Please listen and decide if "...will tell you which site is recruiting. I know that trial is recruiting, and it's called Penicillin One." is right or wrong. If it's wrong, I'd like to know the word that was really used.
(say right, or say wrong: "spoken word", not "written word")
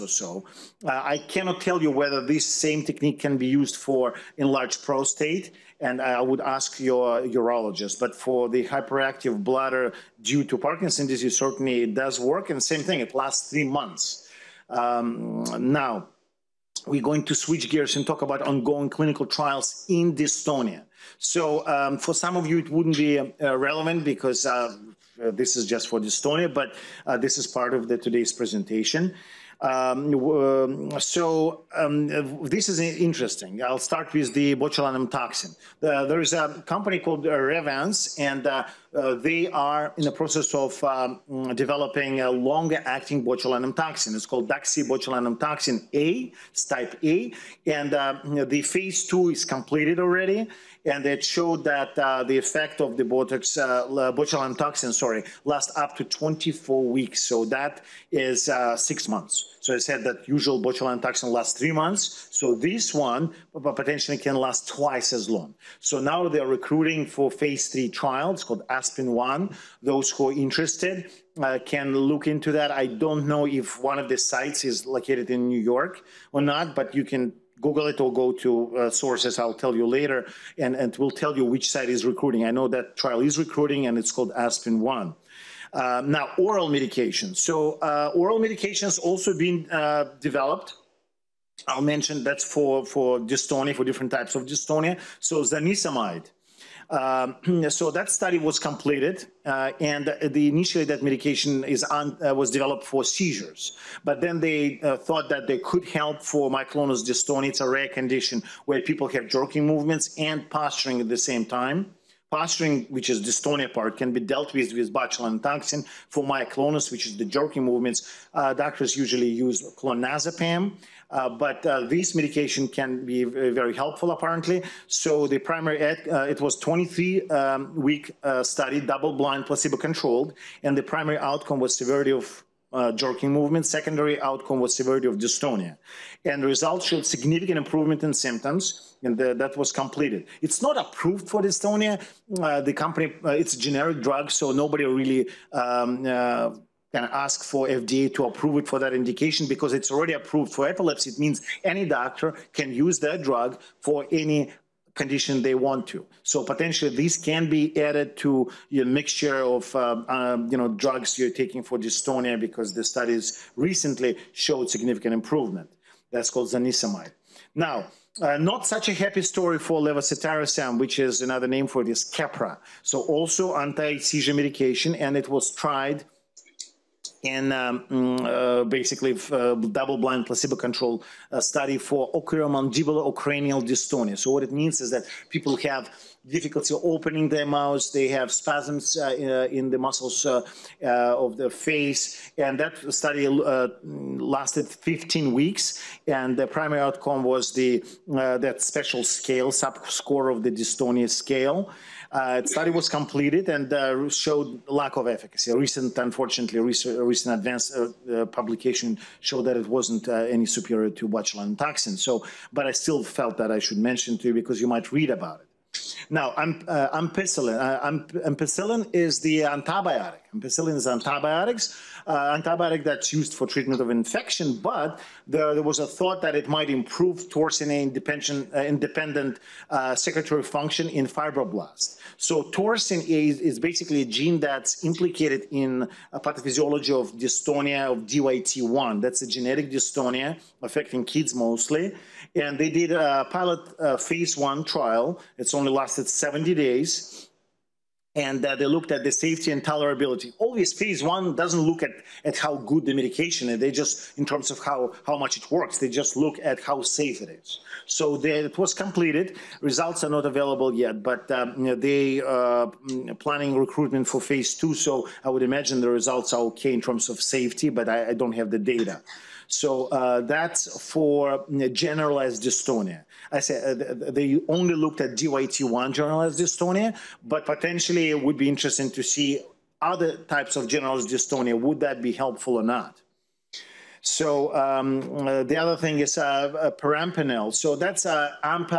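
wrong: "Aspen", not "Penicillin".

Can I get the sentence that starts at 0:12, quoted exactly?
And same thing, it lasts three months.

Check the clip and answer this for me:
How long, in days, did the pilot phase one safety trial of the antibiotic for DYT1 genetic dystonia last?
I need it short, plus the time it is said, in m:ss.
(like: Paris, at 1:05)
70 days, at 4:06.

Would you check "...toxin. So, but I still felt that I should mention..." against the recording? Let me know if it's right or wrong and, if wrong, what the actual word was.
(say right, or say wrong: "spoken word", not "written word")
right.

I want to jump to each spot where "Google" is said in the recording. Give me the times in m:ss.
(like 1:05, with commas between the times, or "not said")
1:17.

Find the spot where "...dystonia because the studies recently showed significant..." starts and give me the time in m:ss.
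2:41.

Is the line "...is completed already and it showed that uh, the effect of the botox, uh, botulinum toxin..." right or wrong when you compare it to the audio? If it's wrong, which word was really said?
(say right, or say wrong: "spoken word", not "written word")
right.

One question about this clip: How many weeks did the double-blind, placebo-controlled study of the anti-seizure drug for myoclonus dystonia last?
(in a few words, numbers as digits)
23.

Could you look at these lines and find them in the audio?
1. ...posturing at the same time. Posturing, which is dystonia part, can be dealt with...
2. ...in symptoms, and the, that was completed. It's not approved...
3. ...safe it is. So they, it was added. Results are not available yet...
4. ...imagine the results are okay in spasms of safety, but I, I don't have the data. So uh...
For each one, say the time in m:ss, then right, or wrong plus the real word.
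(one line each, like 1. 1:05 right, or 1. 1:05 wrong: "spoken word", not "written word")
1. 1:50 right
2. 2:18 right
3. 4:16 wrong: "completed", not "added"
4. 4:25 wrong: "terms", not "spasms".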